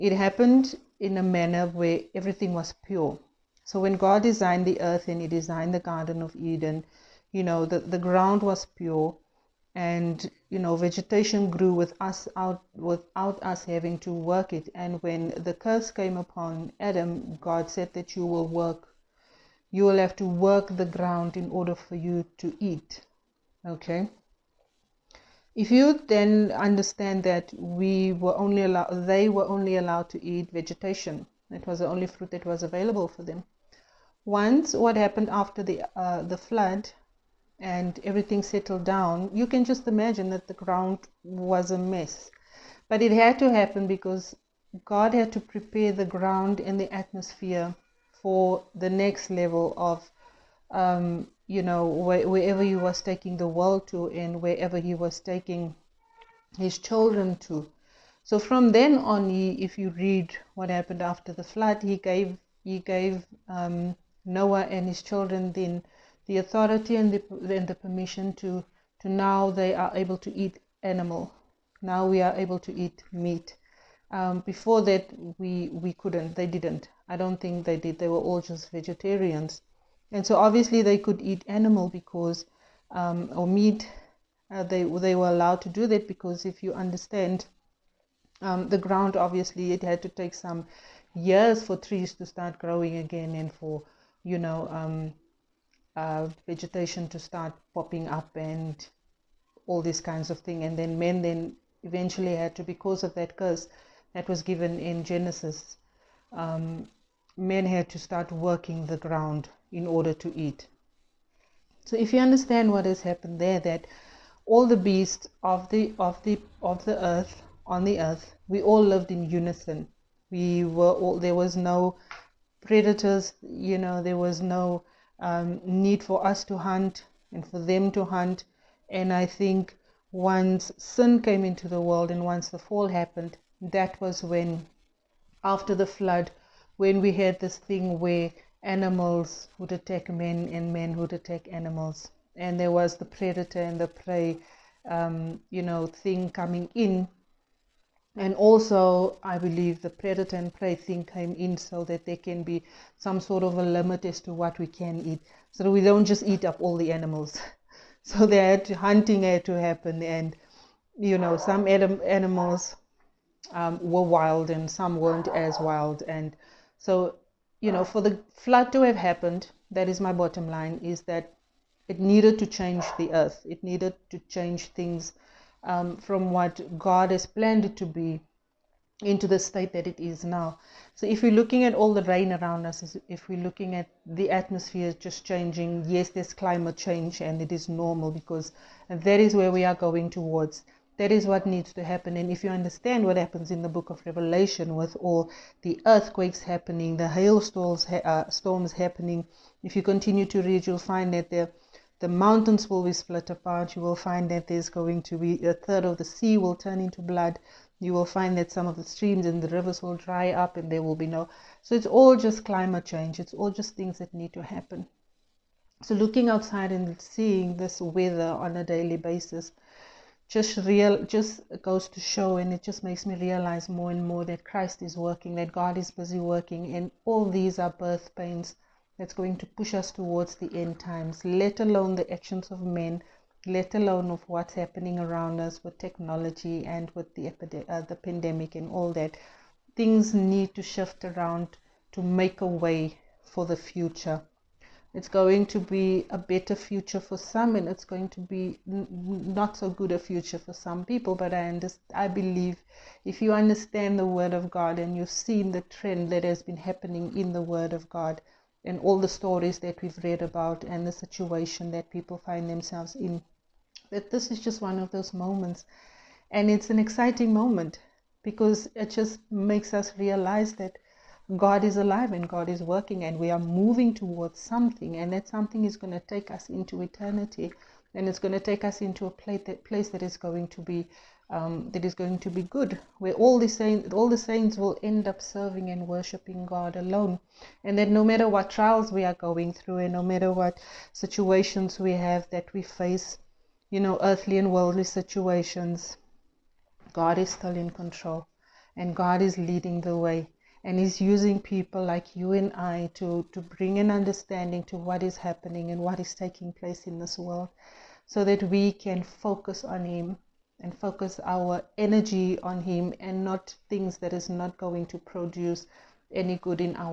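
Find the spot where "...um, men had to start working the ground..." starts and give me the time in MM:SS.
01:46.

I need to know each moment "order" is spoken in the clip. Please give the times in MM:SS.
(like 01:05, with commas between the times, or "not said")
00:21, 01:49.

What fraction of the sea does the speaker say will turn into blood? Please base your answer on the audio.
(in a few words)
A third.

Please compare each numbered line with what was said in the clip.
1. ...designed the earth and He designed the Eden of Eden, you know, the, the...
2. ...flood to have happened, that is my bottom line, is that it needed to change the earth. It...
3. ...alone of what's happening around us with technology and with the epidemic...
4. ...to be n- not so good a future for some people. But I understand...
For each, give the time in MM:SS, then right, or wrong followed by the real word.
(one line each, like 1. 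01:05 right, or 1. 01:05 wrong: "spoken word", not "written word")
1. 00:04 wrong: "Garden", not "Eden"
2. 02:48 right
3. 03:53 right
4. 04:08 right.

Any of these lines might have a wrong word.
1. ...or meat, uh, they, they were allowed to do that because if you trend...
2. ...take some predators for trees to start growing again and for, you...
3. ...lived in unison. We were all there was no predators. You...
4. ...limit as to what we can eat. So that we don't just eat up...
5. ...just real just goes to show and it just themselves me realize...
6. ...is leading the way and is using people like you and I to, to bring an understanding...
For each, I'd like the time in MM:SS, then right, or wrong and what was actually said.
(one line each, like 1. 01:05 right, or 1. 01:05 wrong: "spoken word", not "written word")
1. 01:23 wrong: "understand", not "trend"
2. 01:30 wrong: "years", not "predators"
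3. 01:58 right
4. 02:33 right
5. 03:40 wrong: "makes", not "themselves"
6. 04:59 right.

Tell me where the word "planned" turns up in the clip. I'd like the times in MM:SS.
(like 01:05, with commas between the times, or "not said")
02:57.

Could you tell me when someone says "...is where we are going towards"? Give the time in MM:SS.
03:09.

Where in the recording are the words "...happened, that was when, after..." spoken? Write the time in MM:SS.
02:12.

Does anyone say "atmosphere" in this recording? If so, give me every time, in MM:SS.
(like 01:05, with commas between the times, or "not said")
00:46, 03:04.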